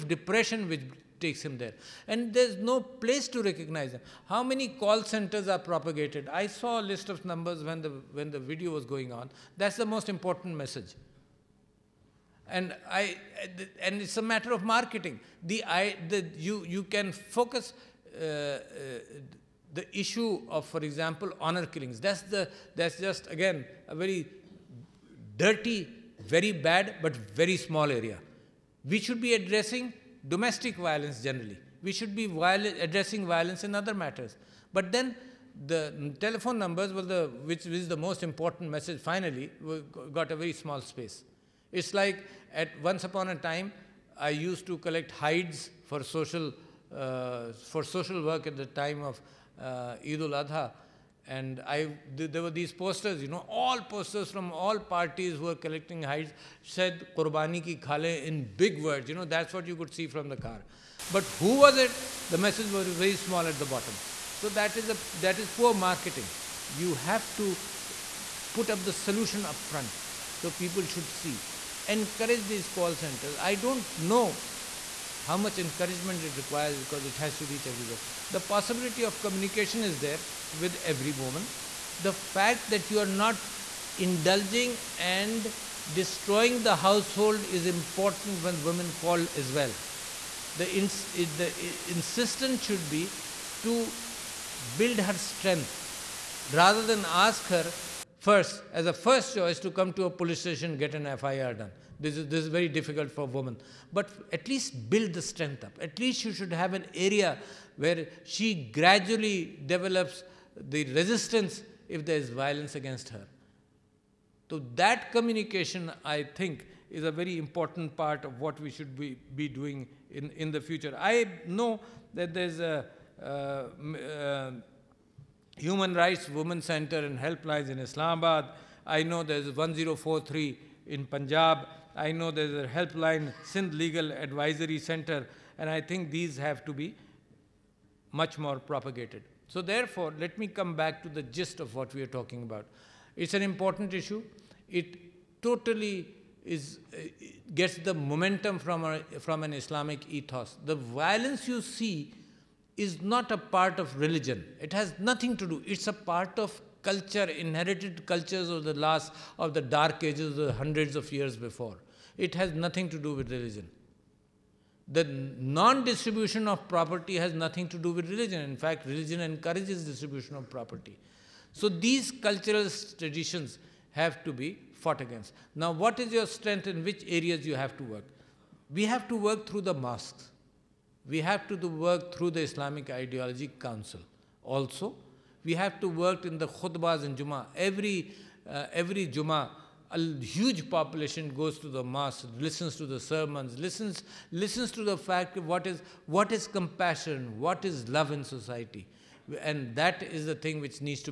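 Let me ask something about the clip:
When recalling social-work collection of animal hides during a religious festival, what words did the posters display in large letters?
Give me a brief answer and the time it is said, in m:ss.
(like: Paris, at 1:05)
Qurbani ki khale, at 0:57.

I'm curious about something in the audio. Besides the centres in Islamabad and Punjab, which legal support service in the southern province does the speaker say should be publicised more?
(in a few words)
Sindh Legal Advisory Center.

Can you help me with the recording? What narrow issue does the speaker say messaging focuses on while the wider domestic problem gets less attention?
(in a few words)
Honor killings.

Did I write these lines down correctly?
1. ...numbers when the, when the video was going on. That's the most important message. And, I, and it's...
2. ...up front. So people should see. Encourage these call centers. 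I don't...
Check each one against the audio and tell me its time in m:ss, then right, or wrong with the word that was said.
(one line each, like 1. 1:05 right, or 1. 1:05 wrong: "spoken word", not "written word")
1. 0:07 right
2. 1:09 right.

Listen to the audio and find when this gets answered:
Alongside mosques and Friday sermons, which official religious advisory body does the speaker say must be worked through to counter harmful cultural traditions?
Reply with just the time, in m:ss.
3:02.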